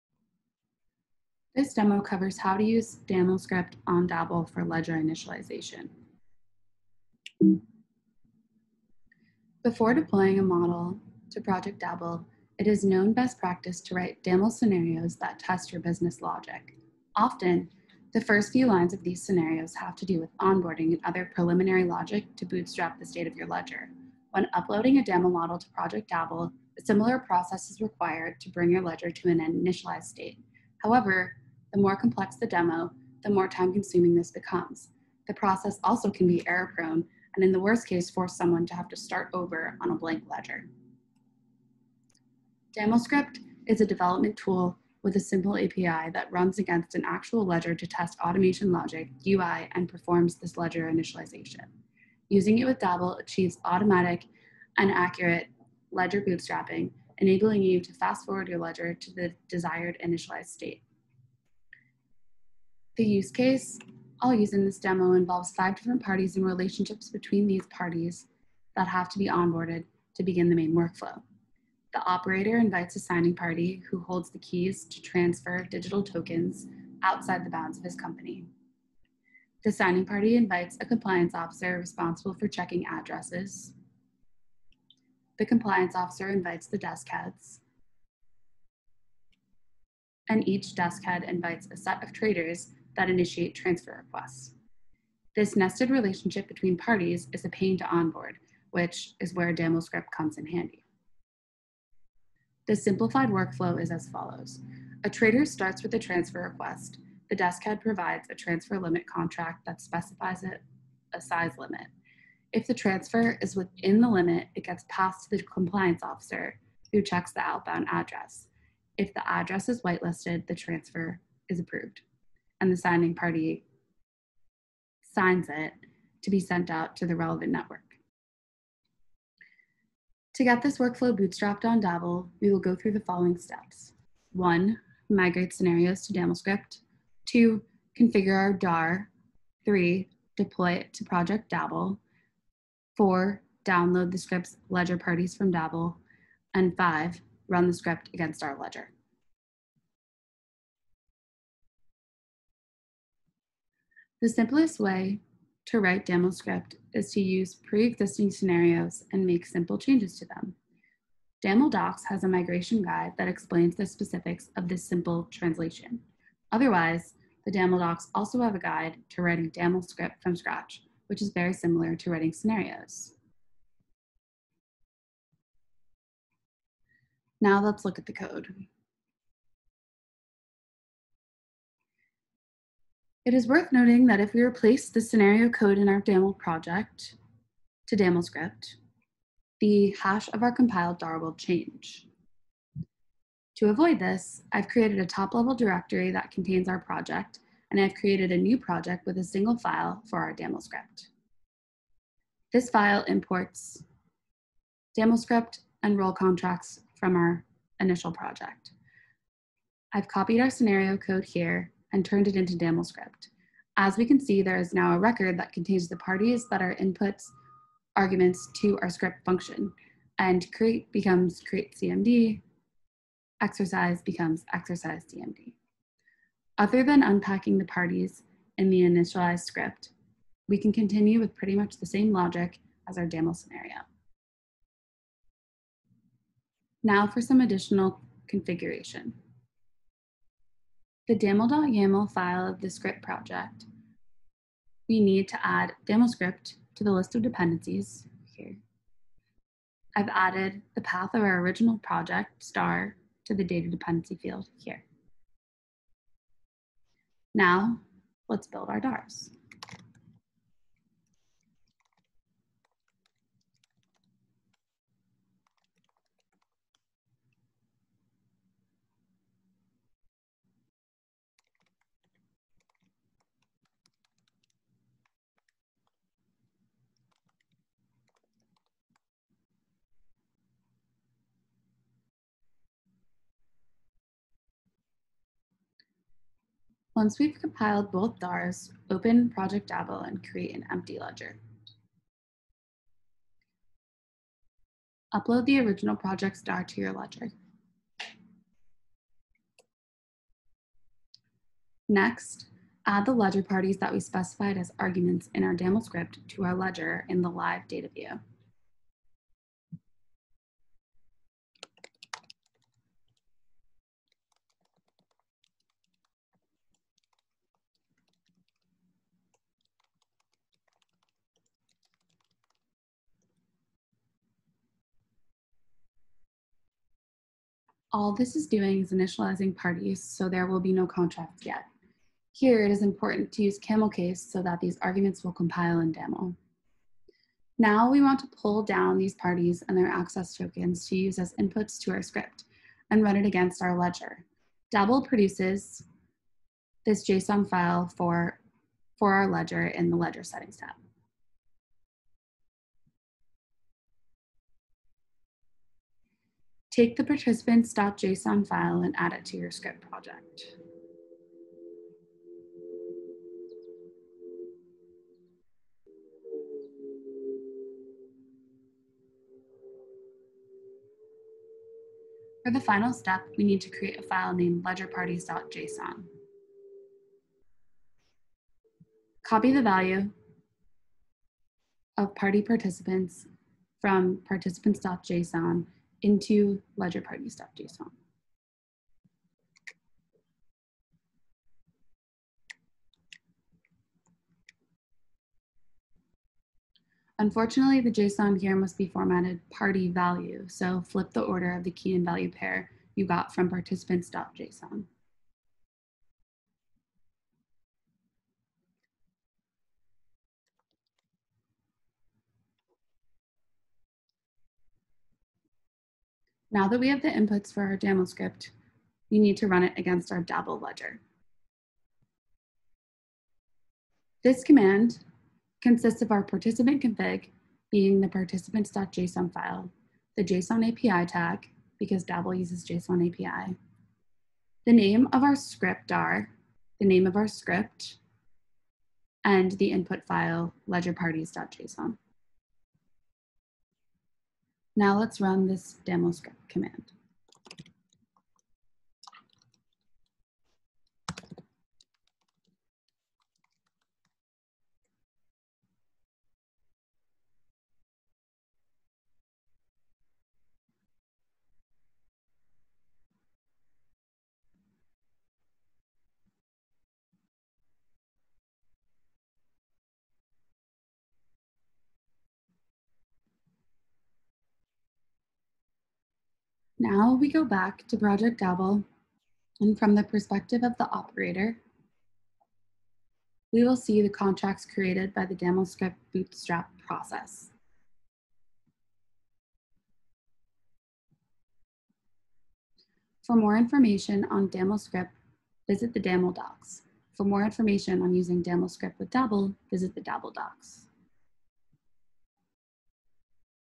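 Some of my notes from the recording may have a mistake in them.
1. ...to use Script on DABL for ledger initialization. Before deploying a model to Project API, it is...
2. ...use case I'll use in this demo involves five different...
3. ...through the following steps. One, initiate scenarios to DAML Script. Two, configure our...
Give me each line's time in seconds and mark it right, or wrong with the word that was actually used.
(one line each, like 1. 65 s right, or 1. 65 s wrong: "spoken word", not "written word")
1. 2 s wrong: "DABL", not "API"
2. 63 s right
3. 132 s wrong: "migrate", not "initiate".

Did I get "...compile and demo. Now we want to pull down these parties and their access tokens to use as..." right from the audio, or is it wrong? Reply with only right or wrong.
right.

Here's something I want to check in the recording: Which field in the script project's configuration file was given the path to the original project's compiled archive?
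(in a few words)
data dependency.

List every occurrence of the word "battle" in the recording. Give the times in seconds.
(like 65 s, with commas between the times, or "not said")
not said.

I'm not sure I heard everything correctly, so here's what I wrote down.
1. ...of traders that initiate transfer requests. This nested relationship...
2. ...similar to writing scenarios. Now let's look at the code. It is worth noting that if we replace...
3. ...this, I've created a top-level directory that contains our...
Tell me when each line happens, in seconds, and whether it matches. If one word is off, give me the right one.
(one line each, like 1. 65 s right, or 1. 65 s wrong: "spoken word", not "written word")
1. 92 s right
2. 171 s right
3. 193 s right.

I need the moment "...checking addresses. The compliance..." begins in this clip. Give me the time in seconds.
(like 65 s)
82 s.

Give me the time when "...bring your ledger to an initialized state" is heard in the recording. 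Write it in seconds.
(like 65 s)
28 s.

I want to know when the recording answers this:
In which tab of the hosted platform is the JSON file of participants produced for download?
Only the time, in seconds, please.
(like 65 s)
349 s.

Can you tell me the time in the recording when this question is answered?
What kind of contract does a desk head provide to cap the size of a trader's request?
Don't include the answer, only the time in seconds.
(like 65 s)
108 s.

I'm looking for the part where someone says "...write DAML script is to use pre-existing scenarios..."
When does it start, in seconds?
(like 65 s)
155 s.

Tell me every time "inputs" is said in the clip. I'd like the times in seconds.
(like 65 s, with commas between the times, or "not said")
216 s, 341 s, 417 s, 439 s.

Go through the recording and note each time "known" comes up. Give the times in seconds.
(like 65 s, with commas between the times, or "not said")
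12 s.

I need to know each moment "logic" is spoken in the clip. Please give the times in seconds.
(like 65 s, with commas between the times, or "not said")
16 s, 21 s, 48 s, 232 s.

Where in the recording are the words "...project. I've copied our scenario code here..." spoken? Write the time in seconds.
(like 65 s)
208 s.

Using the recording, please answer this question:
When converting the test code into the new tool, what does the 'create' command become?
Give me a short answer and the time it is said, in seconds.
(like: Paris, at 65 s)
create CMD, at 221 s.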